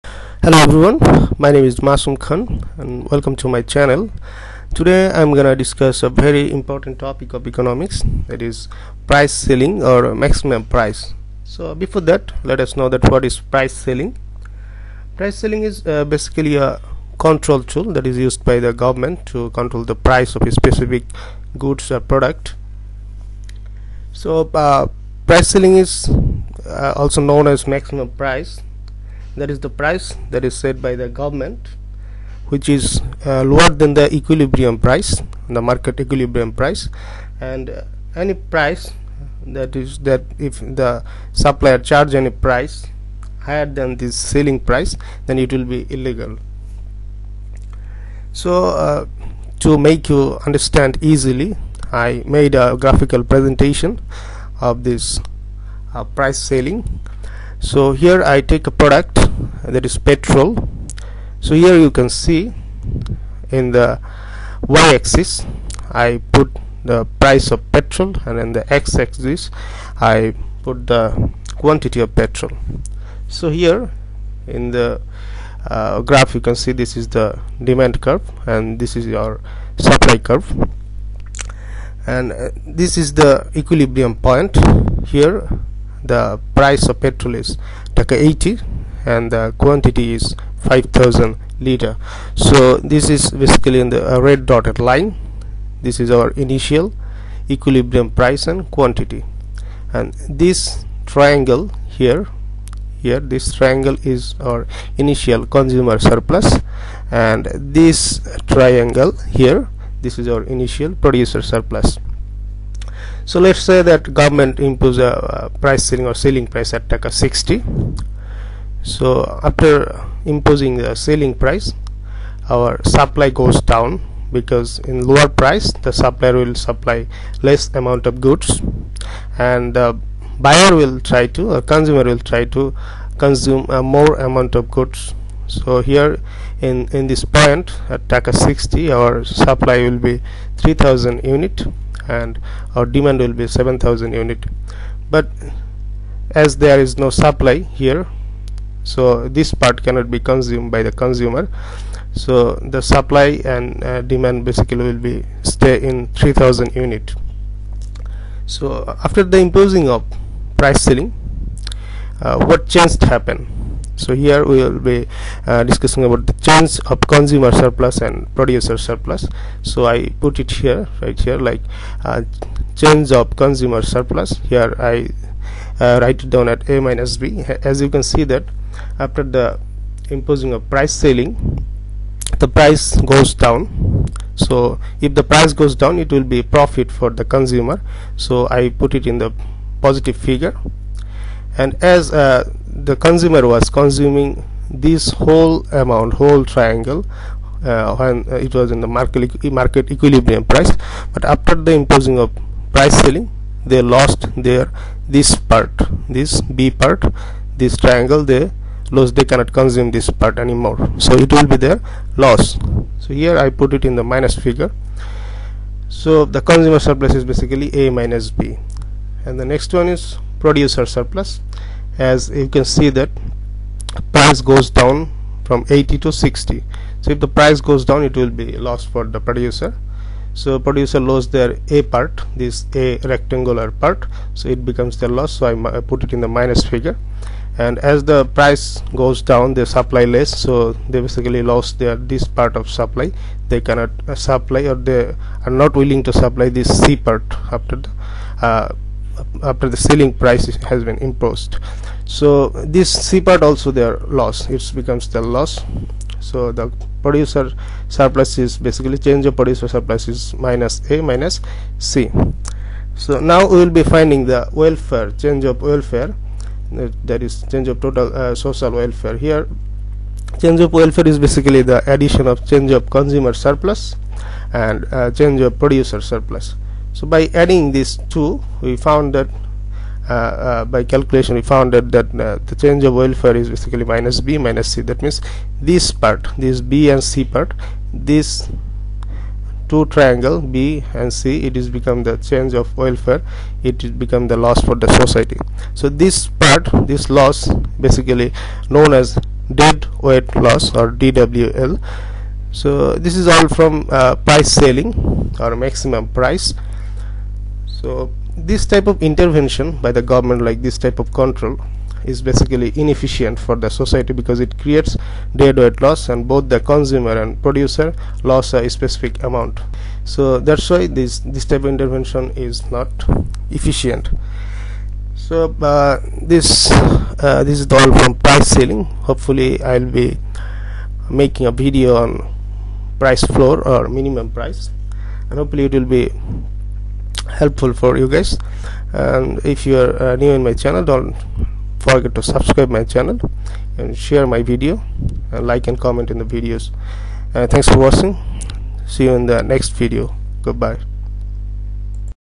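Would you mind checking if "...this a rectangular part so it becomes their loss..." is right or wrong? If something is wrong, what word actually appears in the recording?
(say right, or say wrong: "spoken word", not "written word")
right.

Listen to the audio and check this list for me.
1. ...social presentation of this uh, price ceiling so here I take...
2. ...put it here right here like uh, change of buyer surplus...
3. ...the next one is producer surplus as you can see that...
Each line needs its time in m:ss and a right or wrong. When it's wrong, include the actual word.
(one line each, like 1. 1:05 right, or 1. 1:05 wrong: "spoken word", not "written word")
1. 0:52 wrong: "graphical", not "social"
2. 2:50 wrong: "consumer", not "buyer"
3. 3:39 right.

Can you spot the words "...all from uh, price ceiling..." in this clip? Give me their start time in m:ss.
5:03.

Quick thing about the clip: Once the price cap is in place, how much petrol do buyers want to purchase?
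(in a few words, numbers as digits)
7000 units.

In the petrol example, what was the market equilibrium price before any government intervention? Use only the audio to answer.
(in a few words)
80 taka.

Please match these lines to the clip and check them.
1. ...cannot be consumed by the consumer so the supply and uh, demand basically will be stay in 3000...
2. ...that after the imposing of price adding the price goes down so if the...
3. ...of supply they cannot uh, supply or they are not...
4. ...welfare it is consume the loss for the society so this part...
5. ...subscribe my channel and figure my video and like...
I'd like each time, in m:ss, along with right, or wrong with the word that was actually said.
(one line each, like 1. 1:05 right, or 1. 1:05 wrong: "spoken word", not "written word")
1. 2:29 right
2. 2:58 wrong: "ceiling", not "adding"
3. 4:02 right
4. 4:52 wrong: "become", not "consume"
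5. 5:42 wrong: "share", not "figure".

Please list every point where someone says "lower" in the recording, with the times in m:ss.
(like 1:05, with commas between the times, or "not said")
0:33, 2:05.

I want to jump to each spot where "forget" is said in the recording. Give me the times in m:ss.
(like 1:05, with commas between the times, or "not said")
5:41.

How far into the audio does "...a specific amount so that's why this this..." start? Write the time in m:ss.
5:18.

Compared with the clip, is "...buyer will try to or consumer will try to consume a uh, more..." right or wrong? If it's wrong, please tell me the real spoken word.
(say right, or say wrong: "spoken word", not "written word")
right.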